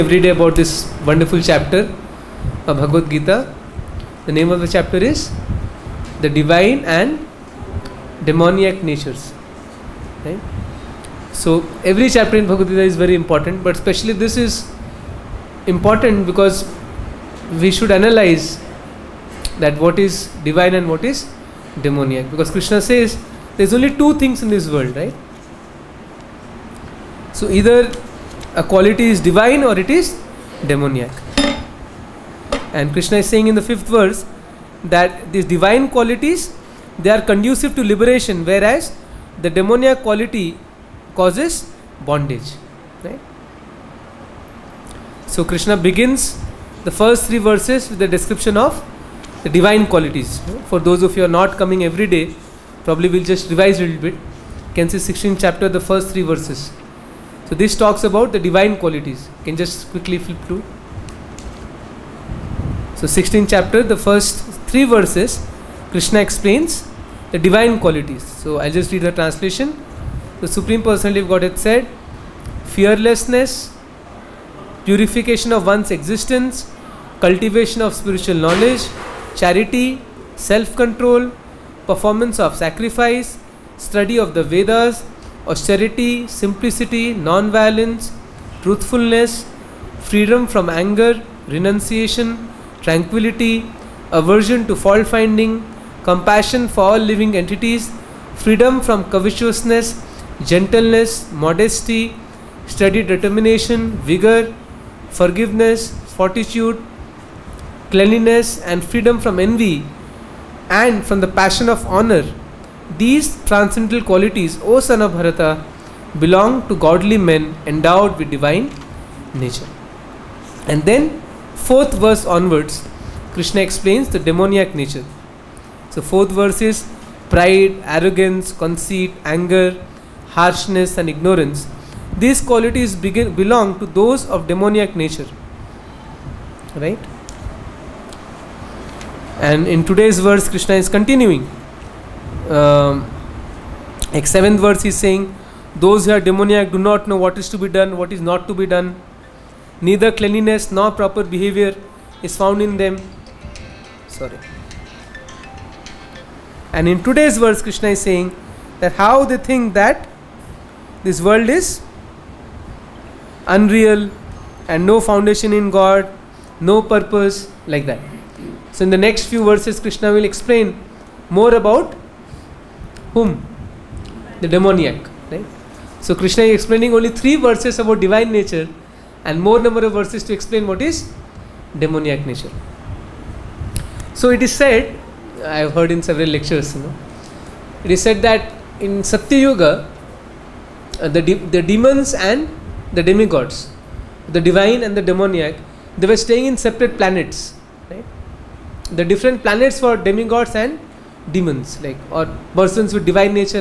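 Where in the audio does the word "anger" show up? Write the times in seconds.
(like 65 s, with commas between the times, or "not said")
90 s, 129 s.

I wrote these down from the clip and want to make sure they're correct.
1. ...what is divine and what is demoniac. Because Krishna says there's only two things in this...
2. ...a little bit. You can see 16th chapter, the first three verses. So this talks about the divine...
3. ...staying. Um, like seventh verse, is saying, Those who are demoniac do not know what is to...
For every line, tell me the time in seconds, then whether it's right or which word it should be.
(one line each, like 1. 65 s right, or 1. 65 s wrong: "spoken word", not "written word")
1. 19 s right
2. 53 s right
3. 140 s wrong: "continuing", not "staying".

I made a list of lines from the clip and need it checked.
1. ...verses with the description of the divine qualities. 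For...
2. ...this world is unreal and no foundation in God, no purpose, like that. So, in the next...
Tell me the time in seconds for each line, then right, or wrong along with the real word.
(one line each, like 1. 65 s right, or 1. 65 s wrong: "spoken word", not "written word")
1. 47 s right
2. 161 s right.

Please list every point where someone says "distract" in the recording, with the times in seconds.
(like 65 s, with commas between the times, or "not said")
not said.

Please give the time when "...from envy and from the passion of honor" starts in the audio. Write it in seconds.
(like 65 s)
109 s.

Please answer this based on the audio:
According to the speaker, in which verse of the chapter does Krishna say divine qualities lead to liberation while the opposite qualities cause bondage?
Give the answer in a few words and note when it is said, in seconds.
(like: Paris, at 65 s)
5th, at 33 s.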